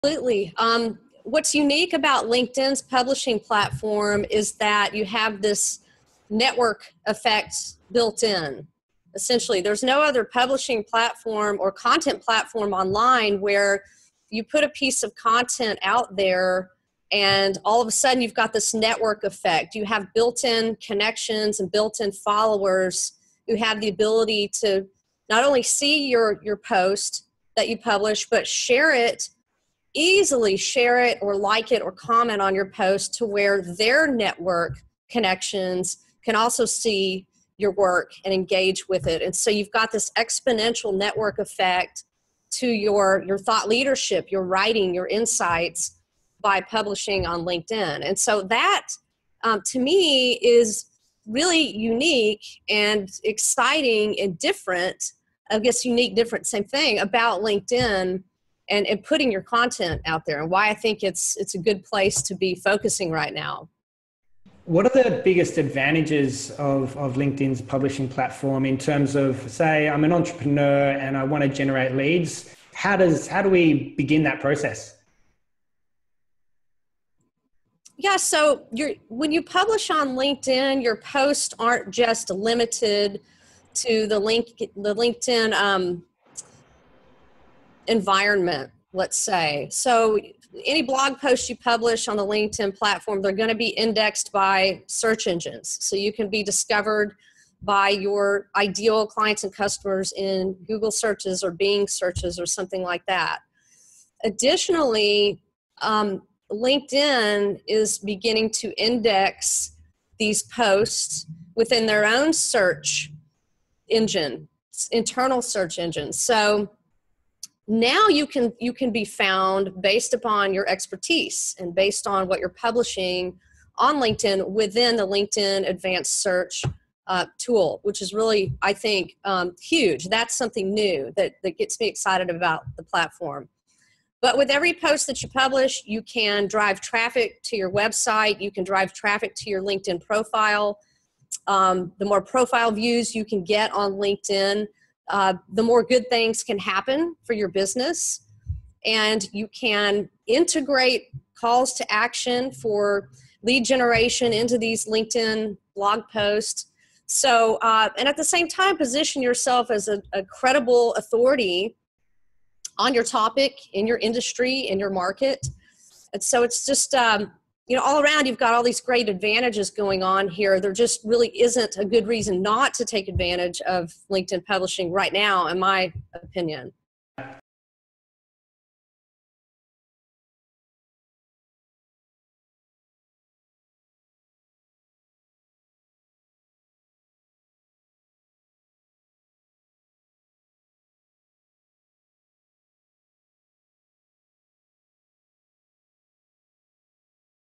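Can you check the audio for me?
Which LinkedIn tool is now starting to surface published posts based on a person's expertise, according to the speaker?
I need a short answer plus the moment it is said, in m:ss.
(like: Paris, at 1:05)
advanced search, at 2:05.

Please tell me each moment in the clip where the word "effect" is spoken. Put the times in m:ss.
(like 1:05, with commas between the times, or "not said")
0:07, 0:19, 0:41.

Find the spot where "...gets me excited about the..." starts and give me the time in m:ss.
2:11.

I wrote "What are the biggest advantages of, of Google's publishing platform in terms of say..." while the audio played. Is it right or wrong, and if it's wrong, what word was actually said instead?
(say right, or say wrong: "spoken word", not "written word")
wrong: "LinkedIn", not "Google".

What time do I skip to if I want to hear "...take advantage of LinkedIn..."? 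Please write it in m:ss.
2:52.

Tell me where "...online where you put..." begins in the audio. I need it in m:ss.
0:12.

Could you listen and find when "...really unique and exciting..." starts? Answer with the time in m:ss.
0:51.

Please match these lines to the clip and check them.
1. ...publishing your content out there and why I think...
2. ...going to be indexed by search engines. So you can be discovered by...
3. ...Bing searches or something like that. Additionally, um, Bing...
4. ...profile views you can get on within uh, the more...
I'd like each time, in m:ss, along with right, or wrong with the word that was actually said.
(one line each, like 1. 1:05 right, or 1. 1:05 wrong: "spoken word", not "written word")
1. 0:59 wrong: "putting", not "publishing"
2. 1:33 right
3. 1:41 wrong: "LinkedIn", not "Bing"
4. 2:22 wrong: "linkedin", not "within".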